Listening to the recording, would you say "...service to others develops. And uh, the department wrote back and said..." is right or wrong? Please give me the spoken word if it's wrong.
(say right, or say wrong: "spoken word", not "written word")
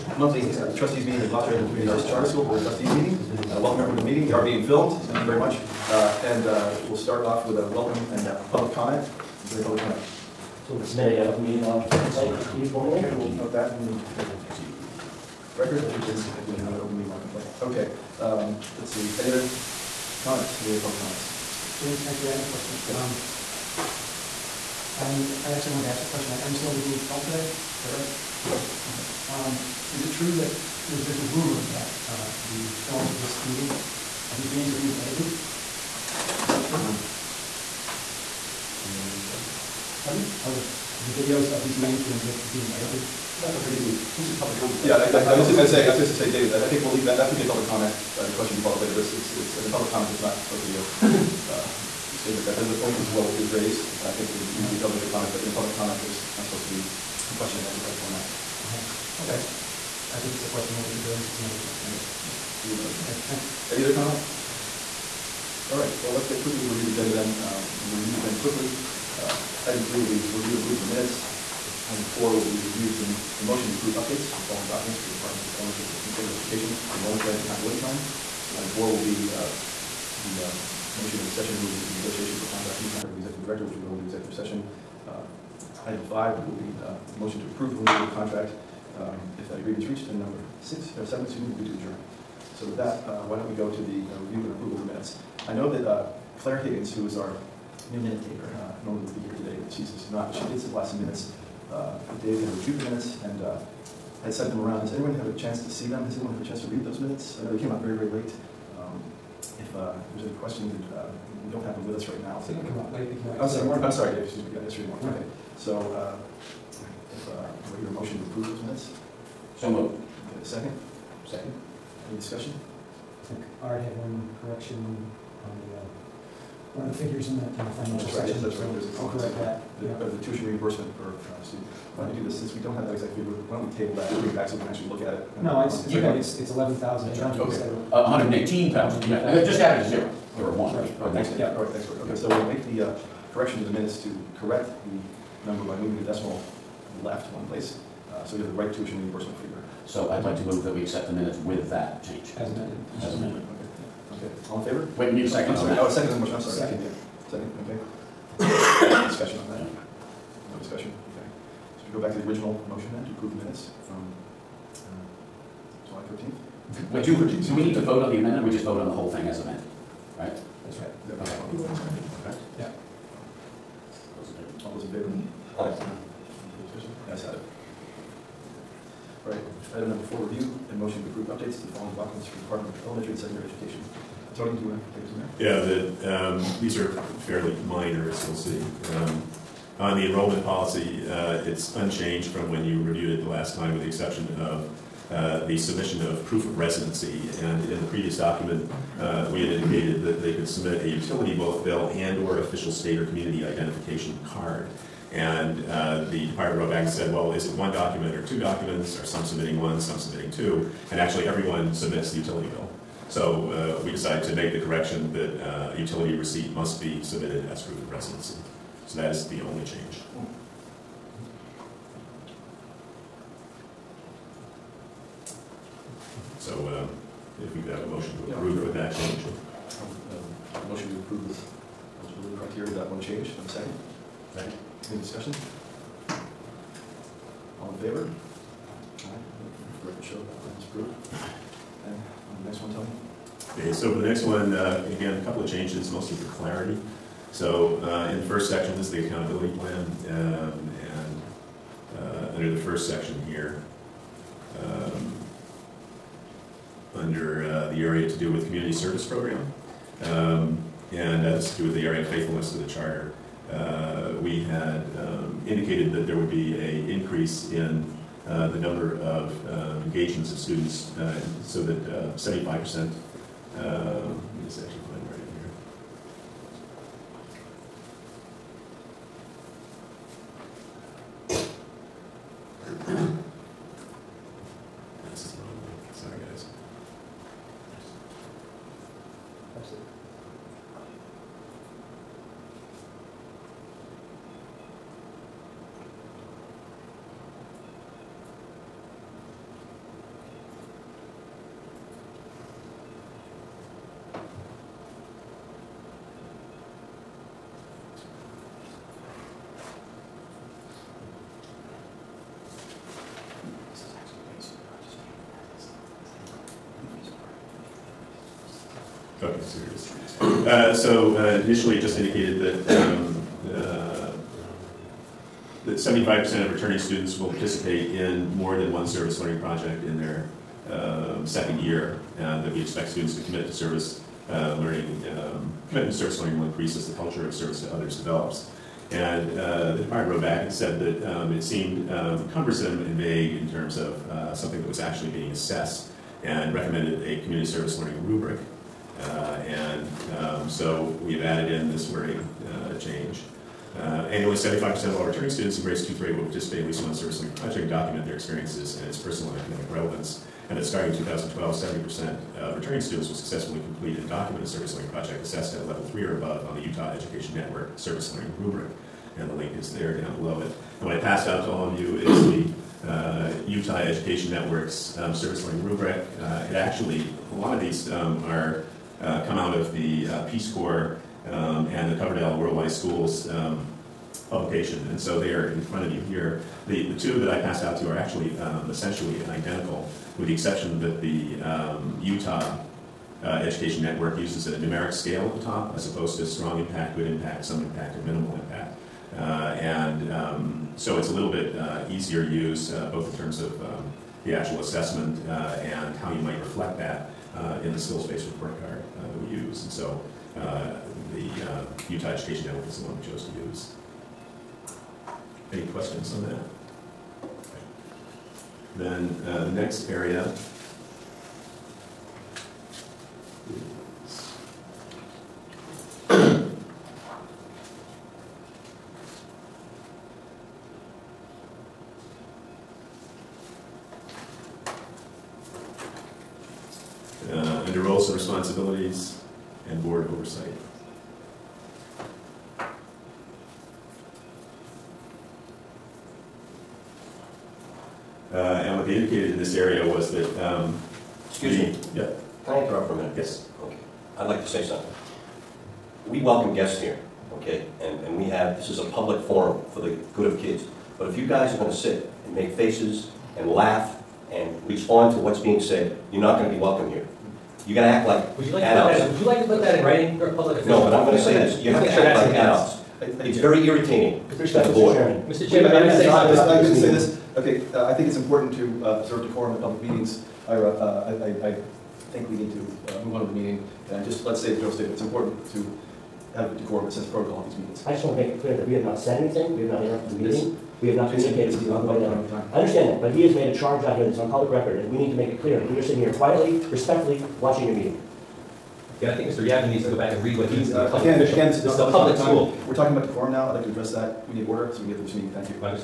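right.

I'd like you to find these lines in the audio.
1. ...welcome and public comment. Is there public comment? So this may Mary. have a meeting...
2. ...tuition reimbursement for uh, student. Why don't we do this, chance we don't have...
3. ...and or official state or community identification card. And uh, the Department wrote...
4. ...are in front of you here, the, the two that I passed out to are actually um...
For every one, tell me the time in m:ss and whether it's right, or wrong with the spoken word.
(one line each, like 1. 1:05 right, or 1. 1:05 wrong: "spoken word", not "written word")
1. 0:07 right
2. 2:10 wrong: "since", not "chance"
3. 3:21 right
4. 6:25 right.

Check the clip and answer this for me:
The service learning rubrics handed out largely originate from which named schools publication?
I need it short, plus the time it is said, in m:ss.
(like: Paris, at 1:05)
Coverdell World Wise Schools, at 6:22.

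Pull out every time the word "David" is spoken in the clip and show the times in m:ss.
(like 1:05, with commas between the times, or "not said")
0:46.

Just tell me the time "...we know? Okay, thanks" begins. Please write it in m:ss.
1:02.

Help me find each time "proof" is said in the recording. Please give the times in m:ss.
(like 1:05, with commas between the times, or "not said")
3:16, 3:37.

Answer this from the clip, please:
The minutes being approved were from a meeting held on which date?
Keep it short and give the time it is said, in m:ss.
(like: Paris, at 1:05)
July 13, at 2:45.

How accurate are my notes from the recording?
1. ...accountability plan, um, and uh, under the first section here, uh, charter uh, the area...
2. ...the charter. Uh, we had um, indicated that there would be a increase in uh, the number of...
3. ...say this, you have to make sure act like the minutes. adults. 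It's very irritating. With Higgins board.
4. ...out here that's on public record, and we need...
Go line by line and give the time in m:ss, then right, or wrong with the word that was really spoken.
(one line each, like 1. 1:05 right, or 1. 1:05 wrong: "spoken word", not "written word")
1. 4:09 wrong: "under", not "charter"
2. 4:22 right
3. 7:51 wrong: "The", not "Higgins"
4. 8:13 right.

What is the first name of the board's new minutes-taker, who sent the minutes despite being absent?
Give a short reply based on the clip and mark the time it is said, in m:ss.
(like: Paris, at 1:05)
Claire, at 1:36.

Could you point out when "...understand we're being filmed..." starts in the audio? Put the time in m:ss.
0:26.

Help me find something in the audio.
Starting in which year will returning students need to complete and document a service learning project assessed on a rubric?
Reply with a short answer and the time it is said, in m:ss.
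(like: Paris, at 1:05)
2012, at 6:00.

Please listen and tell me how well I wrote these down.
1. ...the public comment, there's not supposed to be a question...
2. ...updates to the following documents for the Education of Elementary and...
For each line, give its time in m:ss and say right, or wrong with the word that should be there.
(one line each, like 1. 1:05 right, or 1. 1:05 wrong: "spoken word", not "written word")
1. 0:55 right
2. 3:01 wrong: "Department", not "Education".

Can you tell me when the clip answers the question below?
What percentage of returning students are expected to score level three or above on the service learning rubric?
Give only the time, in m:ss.
6:01.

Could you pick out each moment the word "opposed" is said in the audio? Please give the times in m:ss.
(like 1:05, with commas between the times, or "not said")
6:35.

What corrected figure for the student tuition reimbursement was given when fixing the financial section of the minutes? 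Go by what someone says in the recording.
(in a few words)
eleven thousand eight hundred.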